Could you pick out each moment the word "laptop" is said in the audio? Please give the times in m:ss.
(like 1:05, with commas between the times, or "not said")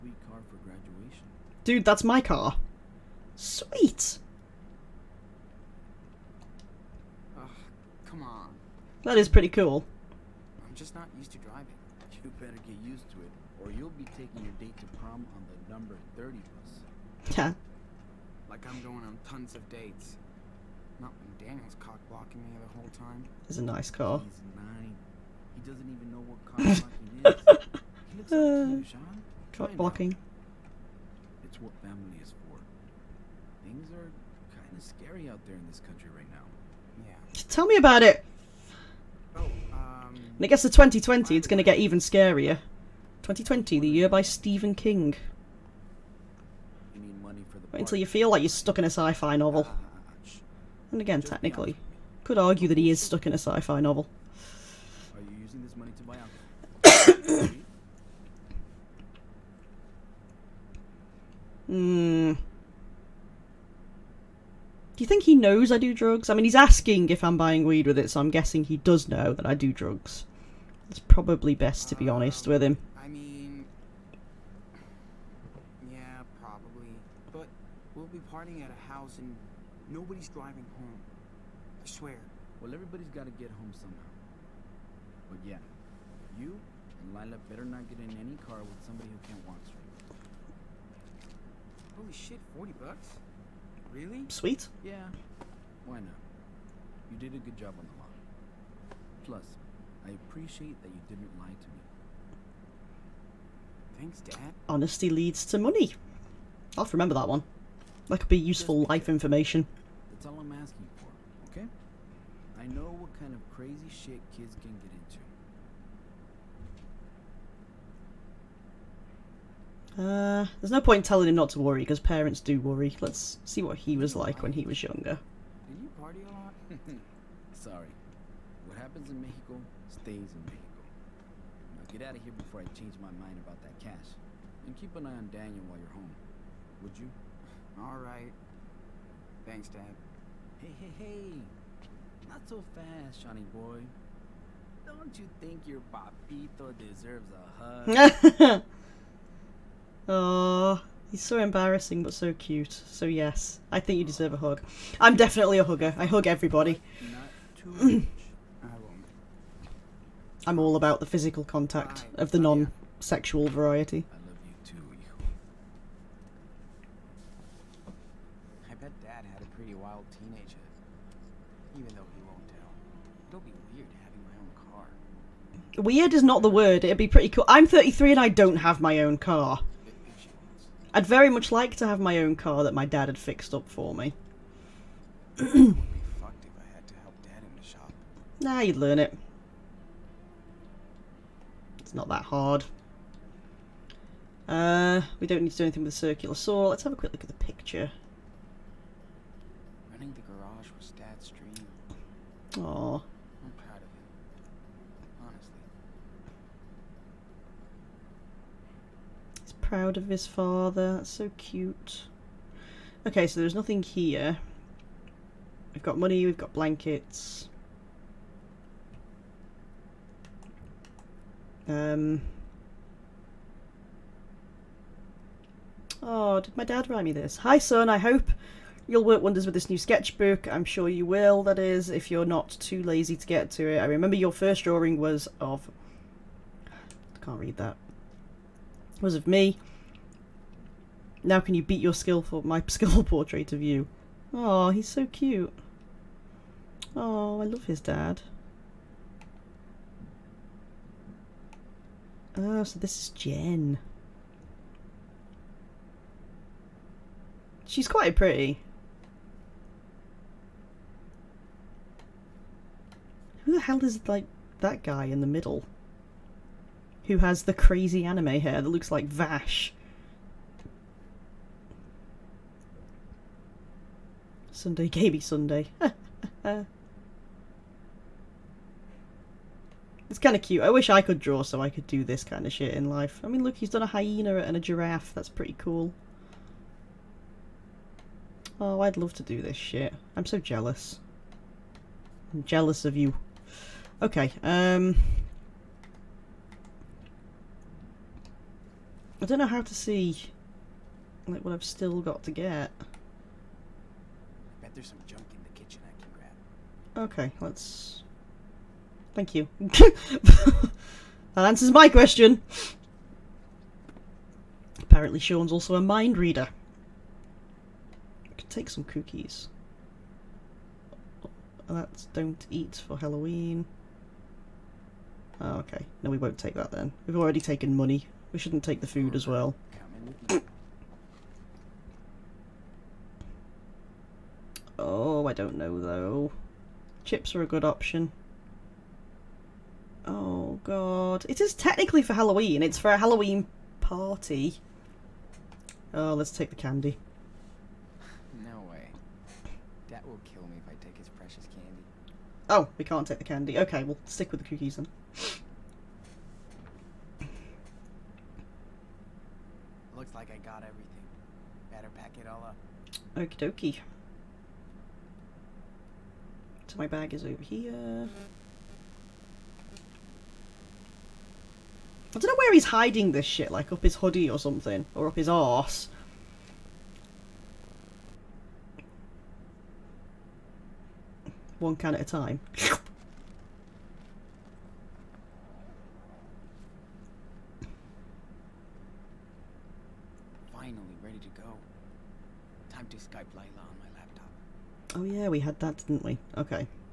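6:33.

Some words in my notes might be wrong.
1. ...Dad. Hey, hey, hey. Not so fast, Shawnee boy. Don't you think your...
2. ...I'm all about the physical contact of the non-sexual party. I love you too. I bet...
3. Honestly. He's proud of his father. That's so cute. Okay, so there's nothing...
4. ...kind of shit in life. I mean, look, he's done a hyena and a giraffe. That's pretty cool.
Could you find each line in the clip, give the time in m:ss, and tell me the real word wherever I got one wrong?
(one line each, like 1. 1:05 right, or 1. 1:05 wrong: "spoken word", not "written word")
1. 2:19 right
2. 2:40 wrong: "variety", not "party"
3. 3:25 right
4. 4:42 right.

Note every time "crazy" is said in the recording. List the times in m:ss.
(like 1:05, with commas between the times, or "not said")
1:53, 4:27.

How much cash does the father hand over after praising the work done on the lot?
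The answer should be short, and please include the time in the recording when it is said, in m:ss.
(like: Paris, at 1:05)
$40, at 1:32.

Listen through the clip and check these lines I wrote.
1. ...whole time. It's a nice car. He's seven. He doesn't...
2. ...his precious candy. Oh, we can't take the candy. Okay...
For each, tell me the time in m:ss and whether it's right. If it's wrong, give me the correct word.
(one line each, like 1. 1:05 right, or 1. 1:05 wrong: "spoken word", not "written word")
1. 0:22 wrong: "nine", not "seven"
2. 5:50 right.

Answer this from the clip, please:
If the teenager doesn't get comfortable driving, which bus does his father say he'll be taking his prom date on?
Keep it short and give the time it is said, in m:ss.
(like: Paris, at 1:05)
30, at 0:15.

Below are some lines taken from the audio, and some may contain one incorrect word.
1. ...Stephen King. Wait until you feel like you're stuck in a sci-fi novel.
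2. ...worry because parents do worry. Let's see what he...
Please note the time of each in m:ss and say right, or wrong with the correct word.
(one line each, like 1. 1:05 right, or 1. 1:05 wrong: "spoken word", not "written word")
1. 0:44 right
2. 2:01 right.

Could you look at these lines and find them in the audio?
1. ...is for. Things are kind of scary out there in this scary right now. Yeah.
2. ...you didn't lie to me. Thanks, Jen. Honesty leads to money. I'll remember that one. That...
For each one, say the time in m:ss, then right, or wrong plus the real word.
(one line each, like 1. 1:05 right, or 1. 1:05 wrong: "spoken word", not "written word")
1. 0:32 wrong: "country", not "scary"
2. 1:40 wrong: "Dad", not "Jen".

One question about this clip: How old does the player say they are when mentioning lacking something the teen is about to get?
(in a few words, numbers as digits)
33.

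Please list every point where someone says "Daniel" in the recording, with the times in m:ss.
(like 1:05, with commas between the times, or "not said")
0:21, 2:15.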